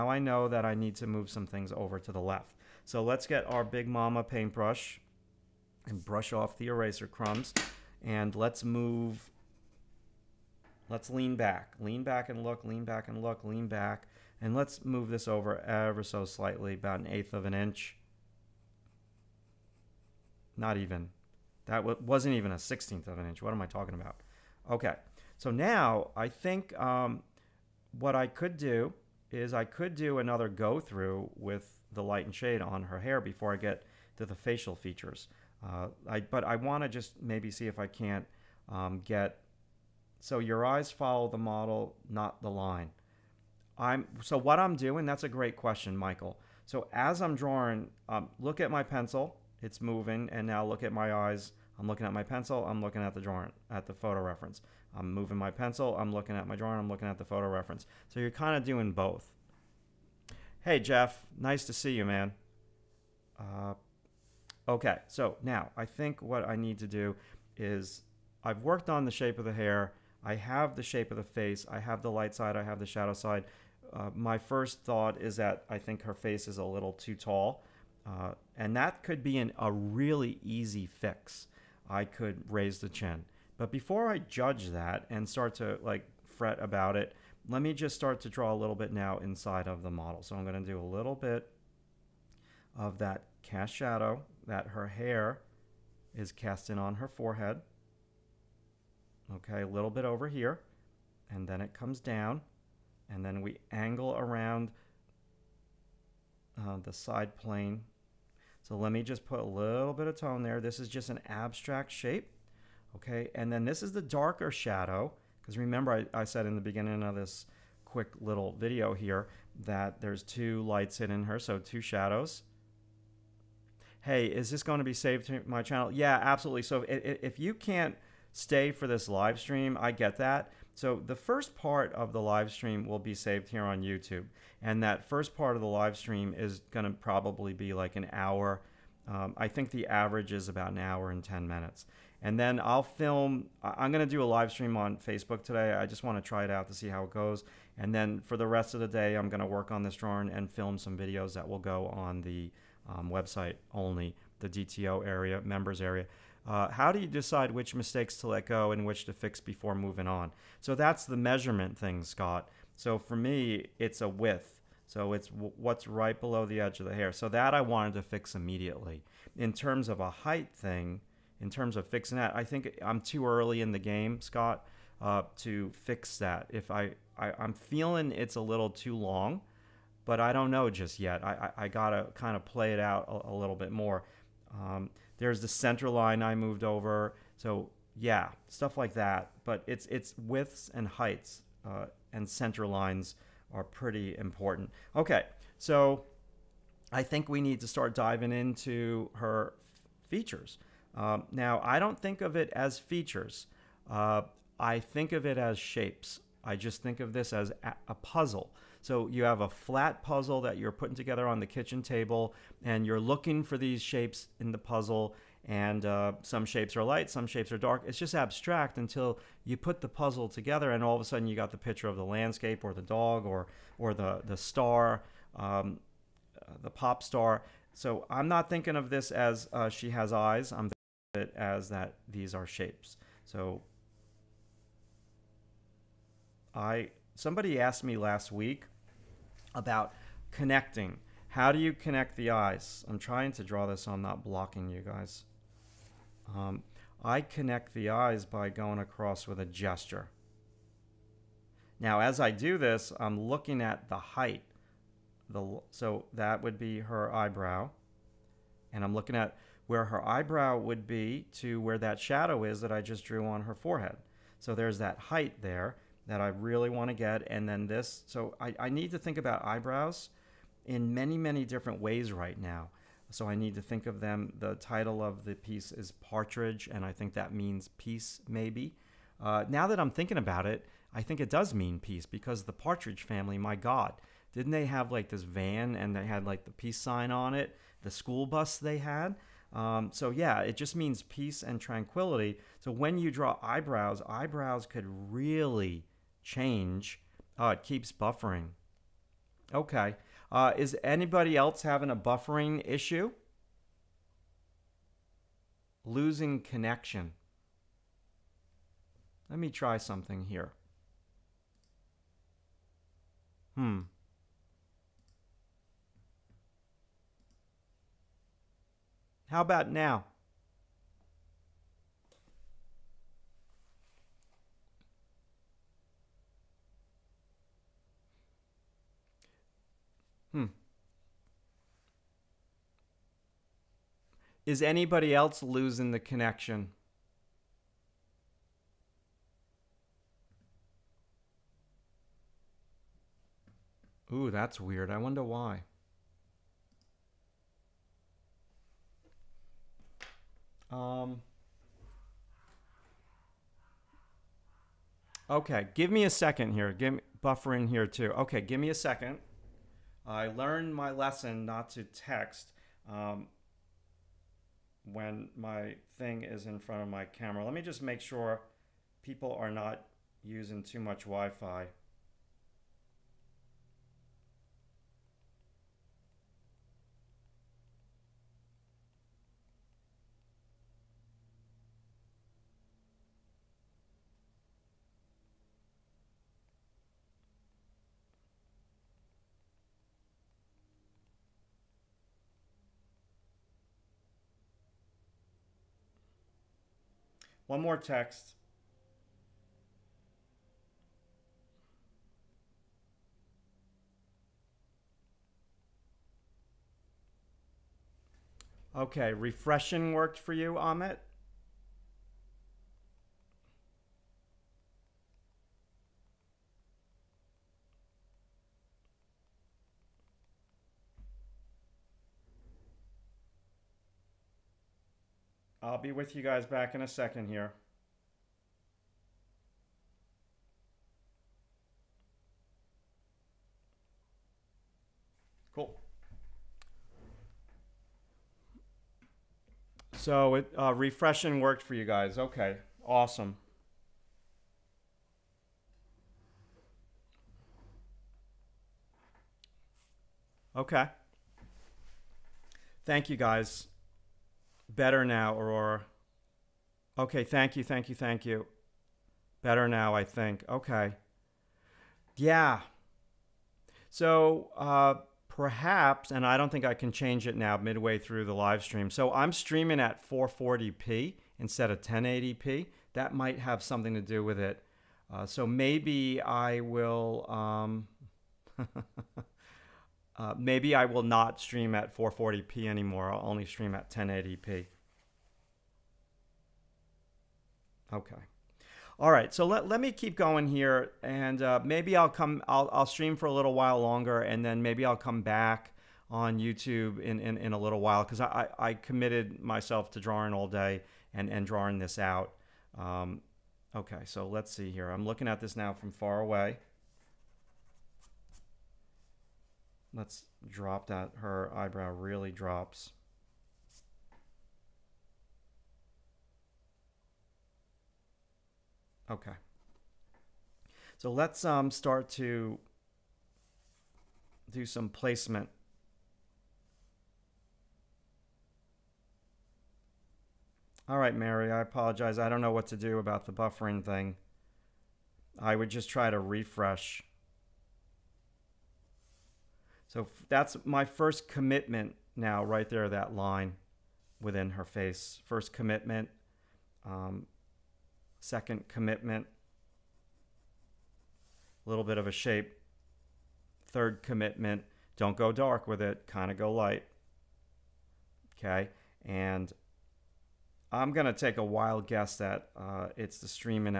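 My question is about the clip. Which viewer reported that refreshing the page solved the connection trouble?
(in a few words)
Amit.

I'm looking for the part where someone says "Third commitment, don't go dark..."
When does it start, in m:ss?
9:13.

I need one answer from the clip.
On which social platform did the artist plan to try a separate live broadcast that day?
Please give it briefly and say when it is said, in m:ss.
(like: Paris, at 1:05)
Facebook, at 2:24.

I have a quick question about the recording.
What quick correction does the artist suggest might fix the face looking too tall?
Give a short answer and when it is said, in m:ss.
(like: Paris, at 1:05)
raise the chin, at 1:22.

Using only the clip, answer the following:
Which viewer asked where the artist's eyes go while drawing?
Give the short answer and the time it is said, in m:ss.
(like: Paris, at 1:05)
Michael, at 0:45.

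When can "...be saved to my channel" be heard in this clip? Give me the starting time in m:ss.
2:04.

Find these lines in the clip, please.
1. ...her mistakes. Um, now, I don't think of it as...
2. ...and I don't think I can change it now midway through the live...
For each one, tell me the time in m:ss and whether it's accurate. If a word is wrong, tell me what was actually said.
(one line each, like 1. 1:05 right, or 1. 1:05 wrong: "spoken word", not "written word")
1. 3:19 wrong: "features", not "mistakes"
2. 7:46 right.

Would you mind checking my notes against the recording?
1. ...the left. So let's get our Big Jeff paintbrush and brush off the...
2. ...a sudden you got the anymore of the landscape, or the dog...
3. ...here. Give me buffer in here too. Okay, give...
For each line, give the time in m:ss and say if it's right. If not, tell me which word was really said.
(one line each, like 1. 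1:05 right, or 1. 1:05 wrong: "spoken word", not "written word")
1. 0:02 wrong: "Mama", not "Jeff"
2. 3:41 wrong: "picture", not "anymore"
3. 5:56 right.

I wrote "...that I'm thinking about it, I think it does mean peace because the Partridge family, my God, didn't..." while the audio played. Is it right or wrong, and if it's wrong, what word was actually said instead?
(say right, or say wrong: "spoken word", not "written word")
right.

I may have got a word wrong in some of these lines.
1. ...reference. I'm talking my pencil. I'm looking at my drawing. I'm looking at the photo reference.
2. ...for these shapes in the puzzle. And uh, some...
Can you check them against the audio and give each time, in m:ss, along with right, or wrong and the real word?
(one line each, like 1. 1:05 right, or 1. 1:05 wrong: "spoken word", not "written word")
1. 0:54 wrong: "moving", not "talking"
2. 3:33 right.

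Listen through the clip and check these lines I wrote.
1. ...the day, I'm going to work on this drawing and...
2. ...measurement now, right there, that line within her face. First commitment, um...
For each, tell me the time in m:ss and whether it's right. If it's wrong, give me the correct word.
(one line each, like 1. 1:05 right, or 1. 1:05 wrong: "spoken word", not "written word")
1. 2:28 right
2. 9:01 wrong: "commitment", not "measurement".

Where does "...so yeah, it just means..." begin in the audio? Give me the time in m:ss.
4:49.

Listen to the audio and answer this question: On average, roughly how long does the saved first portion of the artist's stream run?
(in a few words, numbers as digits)
an hour and 10 minutes.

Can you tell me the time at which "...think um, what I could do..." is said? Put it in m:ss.
0:26.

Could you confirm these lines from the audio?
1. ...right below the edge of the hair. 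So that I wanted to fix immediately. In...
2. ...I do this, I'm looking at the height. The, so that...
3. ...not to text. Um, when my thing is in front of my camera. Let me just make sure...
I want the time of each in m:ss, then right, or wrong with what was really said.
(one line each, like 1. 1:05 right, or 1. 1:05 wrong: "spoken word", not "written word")
1. 2:45 right
2. 4:12 right
3. 6:01 right.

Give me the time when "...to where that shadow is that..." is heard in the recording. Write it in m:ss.
4:21.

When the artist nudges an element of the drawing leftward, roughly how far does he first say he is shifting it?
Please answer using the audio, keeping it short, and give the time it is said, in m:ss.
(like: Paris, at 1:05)
an eighth of an inch, at 0:16.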